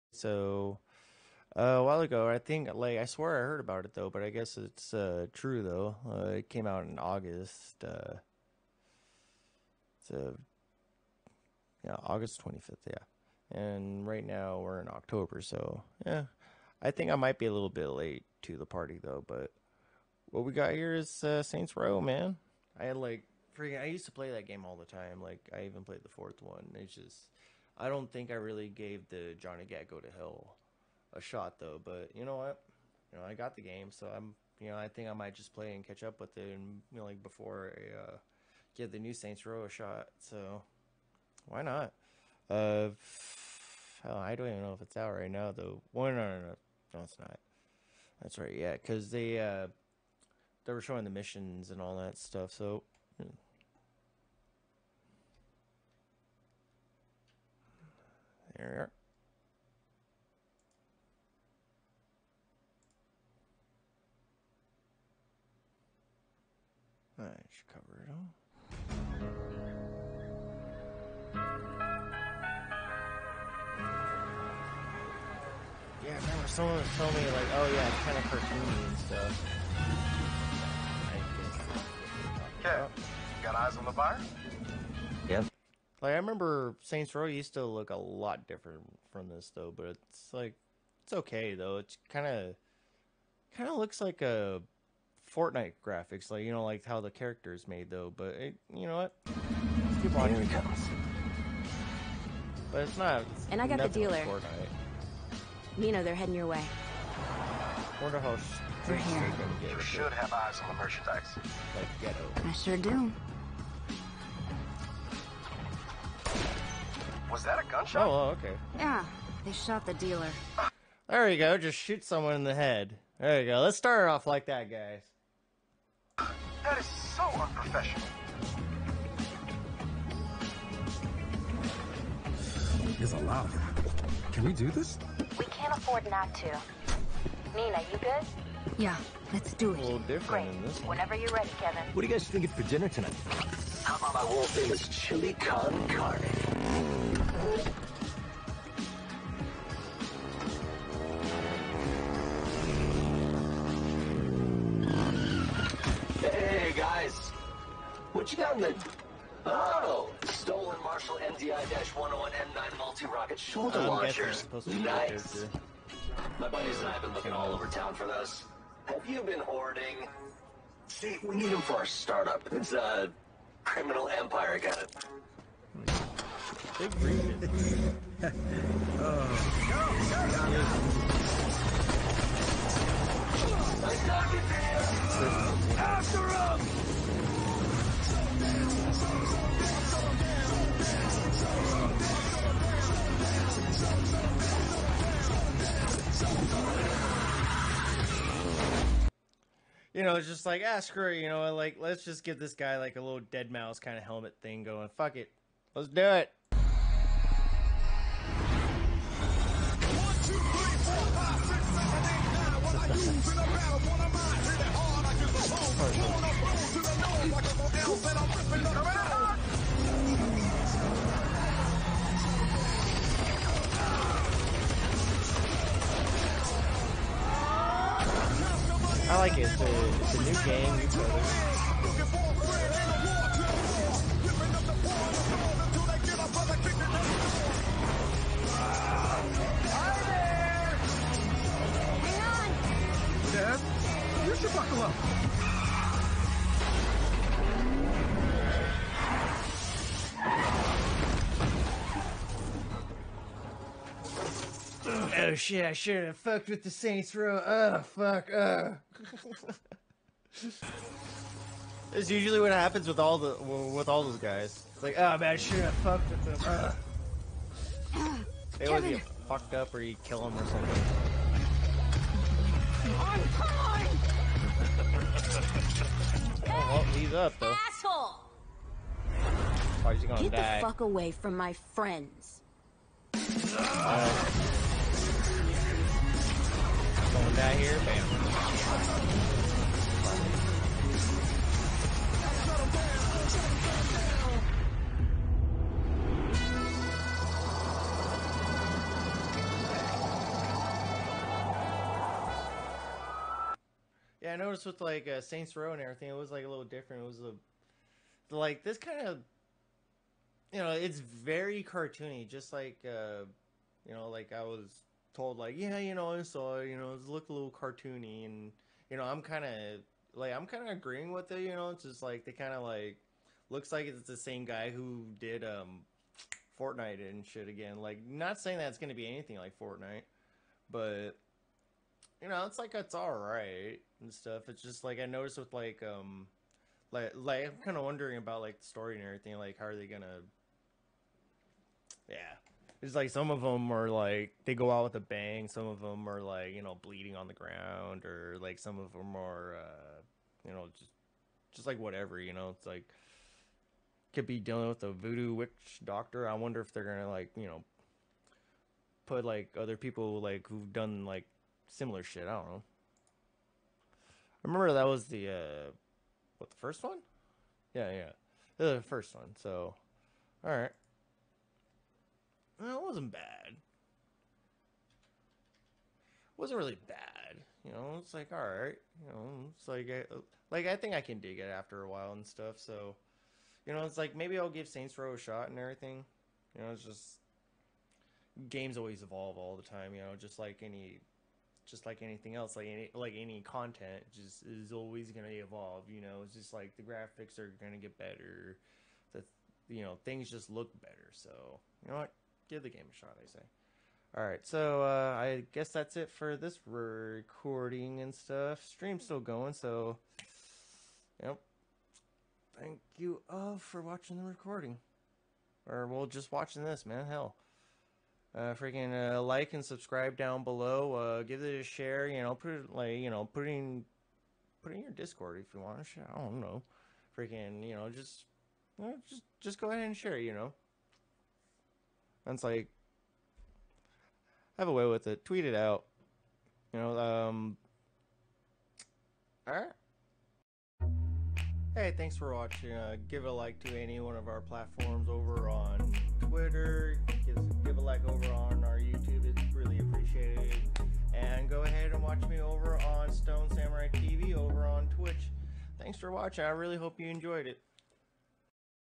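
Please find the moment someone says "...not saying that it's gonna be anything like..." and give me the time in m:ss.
5:28.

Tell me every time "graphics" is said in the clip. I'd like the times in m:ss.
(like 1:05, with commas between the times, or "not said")
1:35, 6:36.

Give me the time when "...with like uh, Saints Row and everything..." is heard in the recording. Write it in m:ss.
5:04.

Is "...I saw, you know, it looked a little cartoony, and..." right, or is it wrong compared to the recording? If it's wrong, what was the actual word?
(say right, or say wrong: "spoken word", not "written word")
right.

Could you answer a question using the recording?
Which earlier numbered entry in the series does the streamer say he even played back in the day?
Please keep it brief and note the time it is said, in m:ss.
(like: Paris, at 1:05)
the fourth one, at 0:26.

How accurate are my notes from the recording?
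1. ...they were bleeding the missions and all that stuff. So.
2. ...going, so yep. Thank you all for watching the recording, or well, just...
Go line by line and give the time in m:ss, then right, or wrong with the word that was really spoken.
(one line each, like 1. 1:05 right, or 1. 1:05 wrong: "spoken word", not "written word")
1. 0:50 wrong: "showing", not "bleeding"
2. 6:49 right.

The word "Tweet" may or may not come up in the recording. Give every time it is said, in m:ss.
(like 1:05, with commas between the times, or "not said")
7:15.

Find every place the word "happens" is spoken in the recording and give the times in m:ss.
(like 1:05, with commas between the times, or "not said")
4:22.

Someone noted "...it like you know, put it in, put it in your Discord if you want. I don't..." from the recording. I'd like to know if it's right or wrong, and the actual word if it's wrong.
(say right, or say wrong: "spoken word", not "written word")
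right.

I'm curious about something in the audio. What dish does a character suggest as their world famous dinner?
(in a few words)
Chili con carne.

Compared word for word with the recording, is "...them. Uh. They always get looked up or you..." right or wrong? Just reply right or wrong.
wrong.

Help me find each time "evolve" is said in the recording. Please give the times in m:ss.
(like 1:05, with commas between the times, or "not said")
6:29, 6:35.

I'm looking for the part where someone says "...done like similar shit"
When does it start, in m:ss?
6:00.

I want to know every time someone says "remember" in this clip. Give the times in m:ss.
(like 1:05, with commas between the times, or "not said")
1:16, 1:26, 6:04.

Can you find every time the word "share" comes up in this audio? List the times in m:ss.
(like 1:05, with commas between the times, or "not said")
7:01, 7:09.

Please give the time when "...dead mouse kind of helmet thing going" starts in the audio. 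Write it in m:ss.
3:23.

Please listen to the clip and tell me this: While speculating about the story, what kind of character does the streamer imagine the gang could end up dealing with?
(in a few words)
a voodoo witch doctor.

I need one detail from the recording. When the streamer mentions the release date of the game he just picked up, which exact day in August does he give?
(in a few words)
August 25th.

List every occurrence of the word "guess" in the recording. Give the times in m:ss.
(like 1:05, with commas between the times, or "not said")
0:04, 6:45.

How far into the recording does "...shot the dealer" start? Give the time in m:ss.
1:59.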